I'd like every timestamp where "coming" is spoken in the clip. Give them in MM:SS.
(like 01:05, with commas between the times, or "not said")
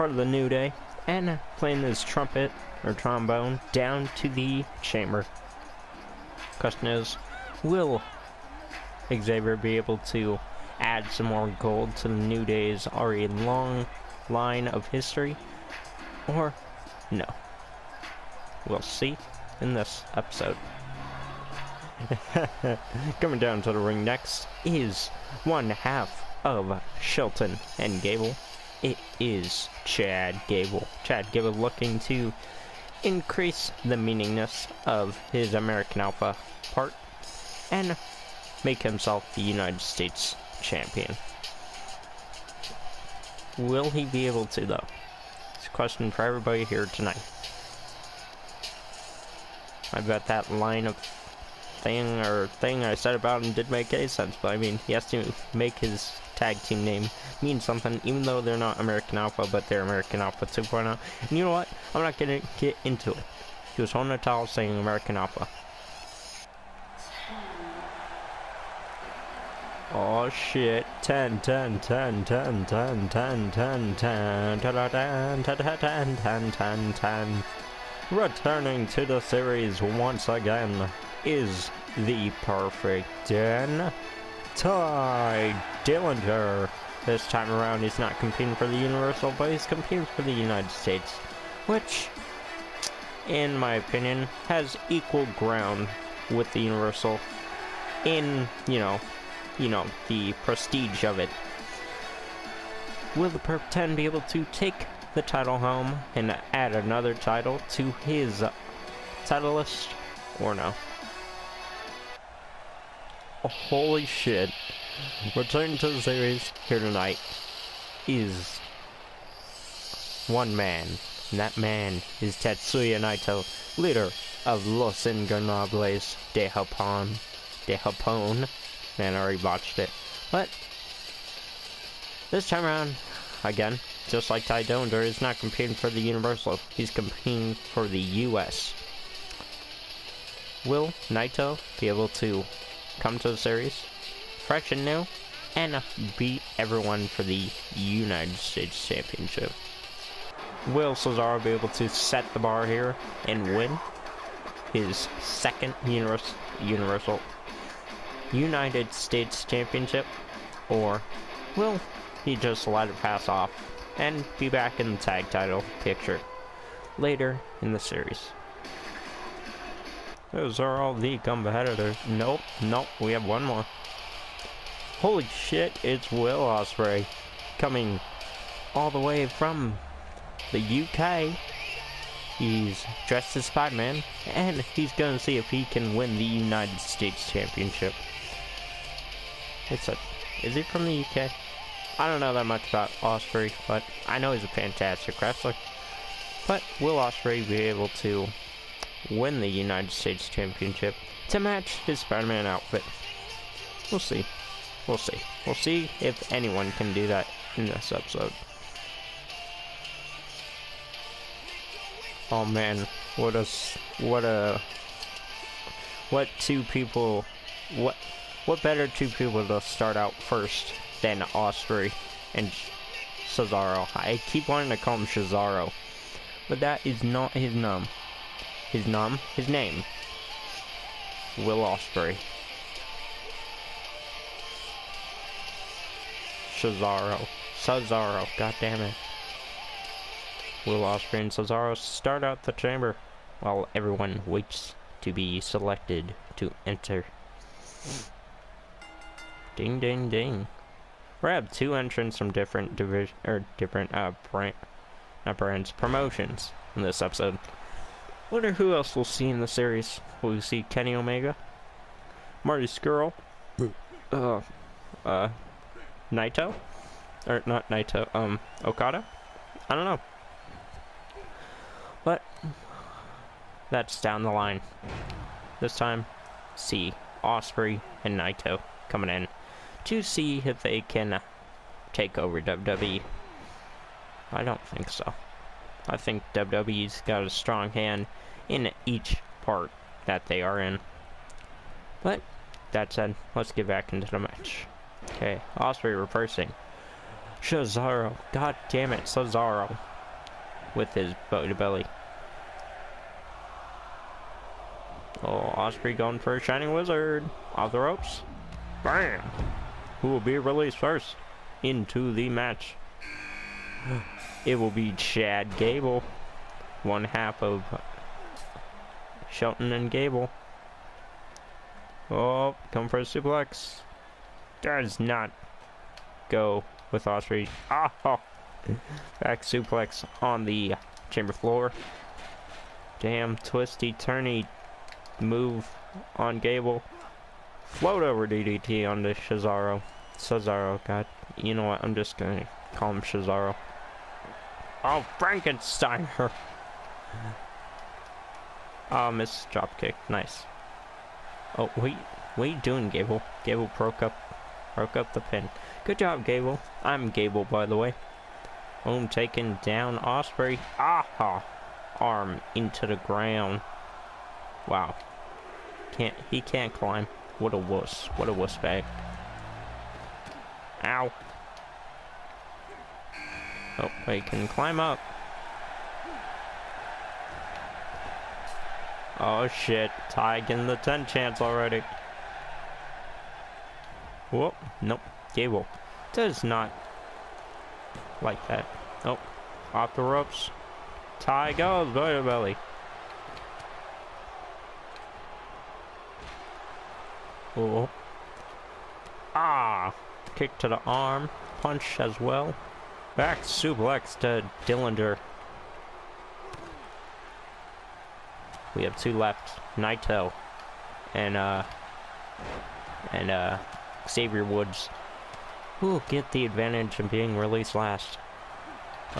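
00:23, 02:57, 04:38.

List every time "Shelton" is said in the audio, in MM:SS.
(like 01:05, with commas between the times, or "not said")
00:27, 05:19.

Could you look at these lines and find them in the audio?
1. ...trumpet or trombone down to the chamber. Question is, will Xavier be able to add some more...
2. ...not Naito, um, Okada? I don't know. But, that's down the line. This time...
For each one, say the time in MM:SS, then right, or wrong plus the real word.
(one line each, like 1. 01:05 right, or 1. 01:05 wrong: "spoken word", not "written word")
1. 00:02 right
2. 04:27 right.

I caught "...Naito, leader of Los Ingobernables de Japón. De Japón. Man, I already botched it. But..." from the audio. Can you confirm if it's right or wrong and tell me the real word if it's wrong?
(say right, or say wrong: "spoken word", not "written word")
right.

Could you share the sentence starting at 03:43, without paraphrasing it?
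I keep wanting to call him Cesaro, but that is not his name.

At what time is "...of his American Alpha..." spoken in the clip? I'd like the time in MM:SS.
00:34.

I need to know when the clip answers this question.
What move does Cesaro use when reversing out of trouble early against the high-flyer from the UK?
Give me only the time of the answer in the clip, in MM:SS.
05:01.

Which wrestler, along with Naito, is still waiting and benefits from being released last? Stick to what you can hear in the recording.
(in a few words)
Xavier Woods.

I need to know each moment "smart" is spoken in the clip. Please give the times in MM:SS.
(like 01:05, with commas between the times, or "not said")
not said.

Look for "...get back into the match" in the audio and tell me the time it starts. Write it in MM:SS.
04:53.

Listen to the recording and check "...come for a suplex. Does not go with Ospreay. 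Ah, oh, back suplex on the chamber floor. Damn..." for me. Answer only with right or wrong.
right.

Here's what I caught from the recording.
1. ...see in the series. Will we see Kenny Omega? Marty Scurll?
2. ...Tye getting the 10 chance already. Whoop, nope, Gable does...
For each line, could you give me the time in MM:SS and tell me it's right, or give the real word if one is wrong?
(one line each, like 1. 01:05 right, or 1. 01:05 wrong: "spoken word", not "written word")
1. 04:19 right
2. 06:20 right.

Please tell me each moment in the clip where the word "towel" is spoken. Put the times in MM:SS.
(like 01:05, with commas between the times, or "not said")
01:04.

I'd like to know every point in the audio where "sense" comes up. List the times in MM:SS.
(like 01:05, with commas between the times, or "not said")
00:54.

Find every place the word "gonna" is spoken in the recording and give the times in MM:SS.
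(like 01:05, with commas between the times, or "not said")
01:02, 05:42.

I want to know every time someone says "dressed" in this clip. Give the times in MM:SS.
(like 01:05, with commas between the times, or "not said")
03:03.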